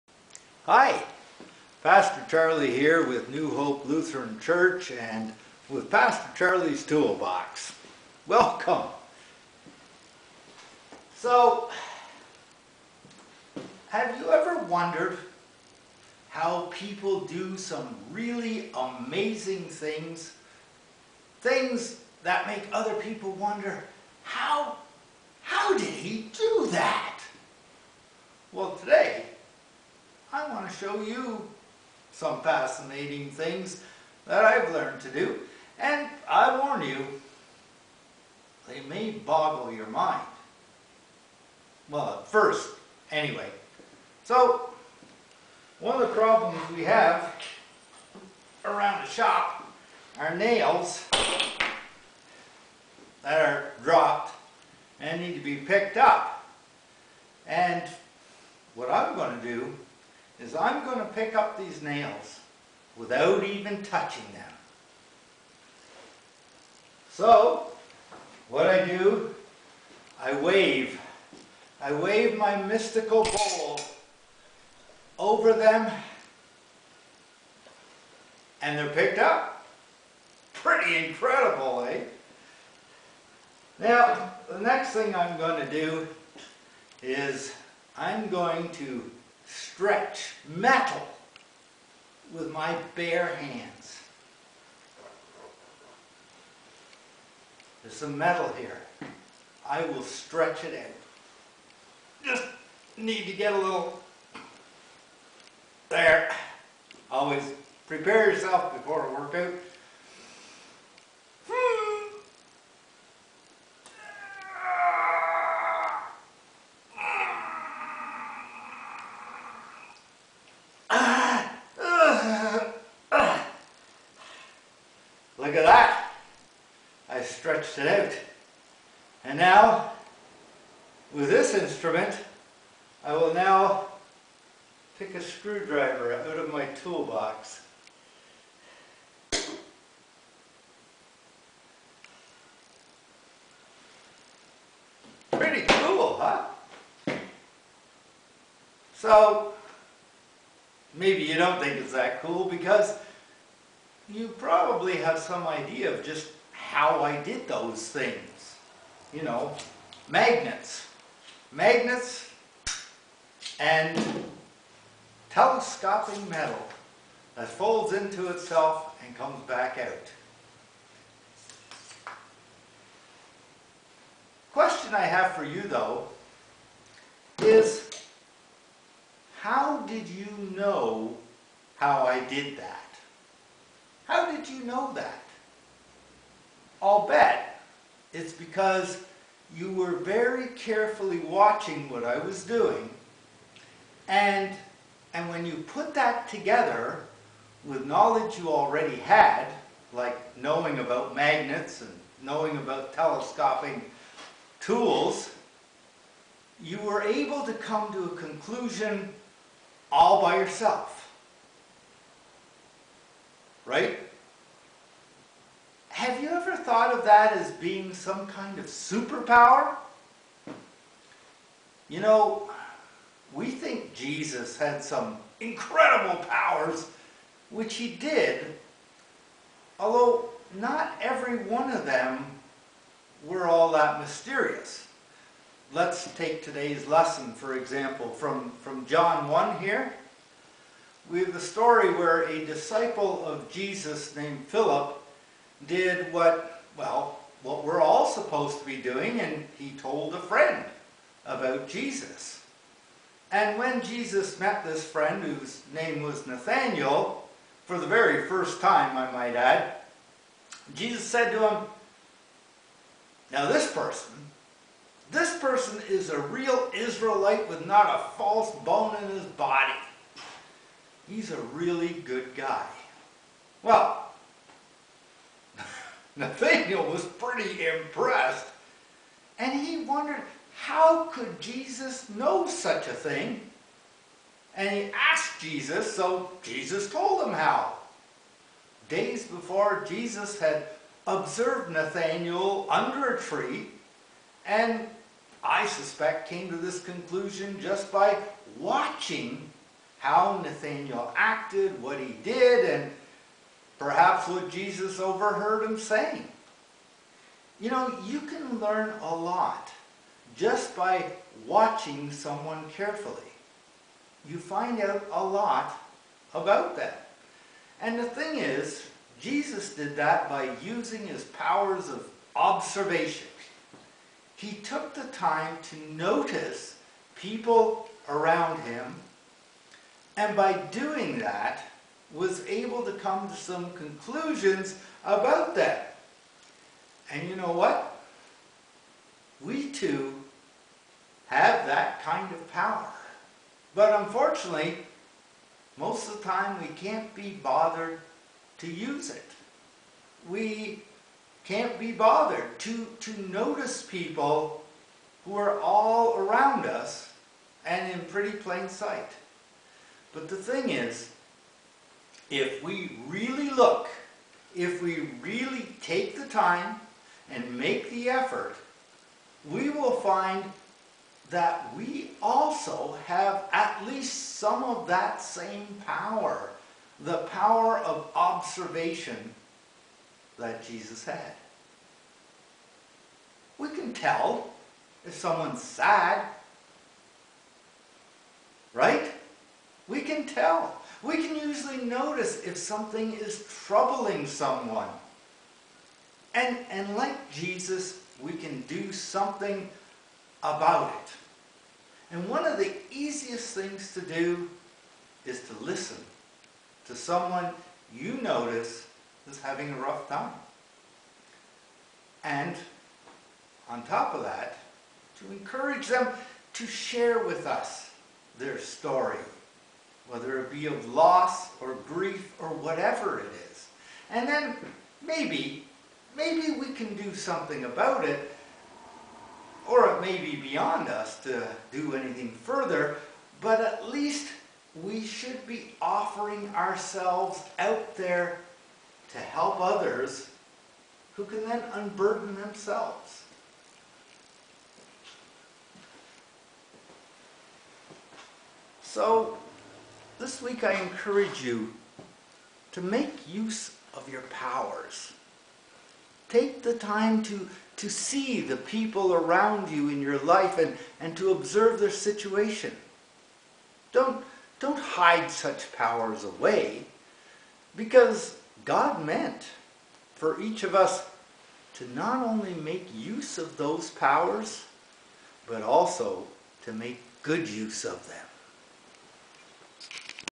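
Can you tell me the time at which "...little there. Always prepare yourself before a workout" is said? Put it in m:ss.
1:43.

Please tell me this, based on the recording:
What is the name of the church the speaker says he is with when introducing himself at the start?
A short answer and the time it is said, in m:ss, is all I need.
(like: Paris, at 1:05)
New Hope Lutheran Church, at 0:03.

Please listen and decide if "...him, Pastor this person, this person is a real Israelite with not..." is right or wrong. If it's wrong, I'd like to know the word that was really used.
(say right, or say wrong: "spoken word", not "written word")
wrong: "Now", not "Pastor".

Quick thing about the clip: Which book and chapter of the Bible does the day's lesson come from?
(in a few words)
John 1.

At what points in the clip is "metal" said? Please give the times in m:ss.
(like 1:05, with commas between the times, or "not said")
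1:30, 1:38, 2:46.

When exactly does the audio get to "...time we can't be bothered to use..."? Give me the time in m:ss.
5:46.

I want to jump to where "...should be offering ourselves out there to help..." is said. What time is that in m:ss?
7:15.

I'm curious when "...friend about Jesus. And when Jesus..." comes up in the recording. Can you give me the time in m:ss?
4:10.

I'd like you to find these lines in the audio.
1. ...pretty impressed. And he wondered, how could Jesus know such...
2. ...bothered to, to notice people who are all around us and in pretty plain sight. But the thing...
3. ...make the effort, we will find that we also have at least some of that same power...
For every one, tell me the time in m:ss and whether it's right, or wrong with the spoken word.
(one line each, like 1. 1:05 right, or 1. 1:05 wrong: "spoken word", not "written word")
1. 4:37 right
2. 5:51 right
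3. 6:07 right.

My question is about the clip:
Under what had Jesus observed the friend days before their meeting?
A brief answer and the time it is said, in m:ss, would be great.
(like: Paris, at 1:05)
A tree, at 4:53.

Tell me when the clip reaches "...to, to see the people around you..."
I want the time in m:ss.
7:37.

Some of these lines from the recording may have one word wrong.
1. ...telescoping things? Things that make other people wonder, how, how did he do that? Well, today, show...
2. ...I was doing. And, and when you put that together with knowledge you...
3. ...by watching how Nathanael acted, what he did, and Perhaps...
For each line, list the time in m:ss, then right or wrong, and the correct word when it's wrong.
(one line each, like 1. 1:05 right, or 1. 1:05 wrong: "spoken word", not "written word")
1. 0:18 wrong: "amazing", not "telescoping"
2. 3:12 right
3. 4:57 right.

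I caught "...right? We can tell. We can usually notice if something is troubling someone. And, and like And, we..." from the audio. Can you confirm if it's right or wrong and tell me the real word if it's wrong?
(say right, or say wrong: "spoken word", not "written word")
wrong: "Jesus", not "And".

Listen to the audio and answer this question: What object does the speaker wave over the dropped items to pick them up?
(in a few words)
Mystical bowl.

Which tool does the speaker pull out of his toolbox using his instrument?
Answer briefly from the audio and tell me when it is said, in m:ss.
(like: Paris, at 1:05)
Screwdriver, at 2:15.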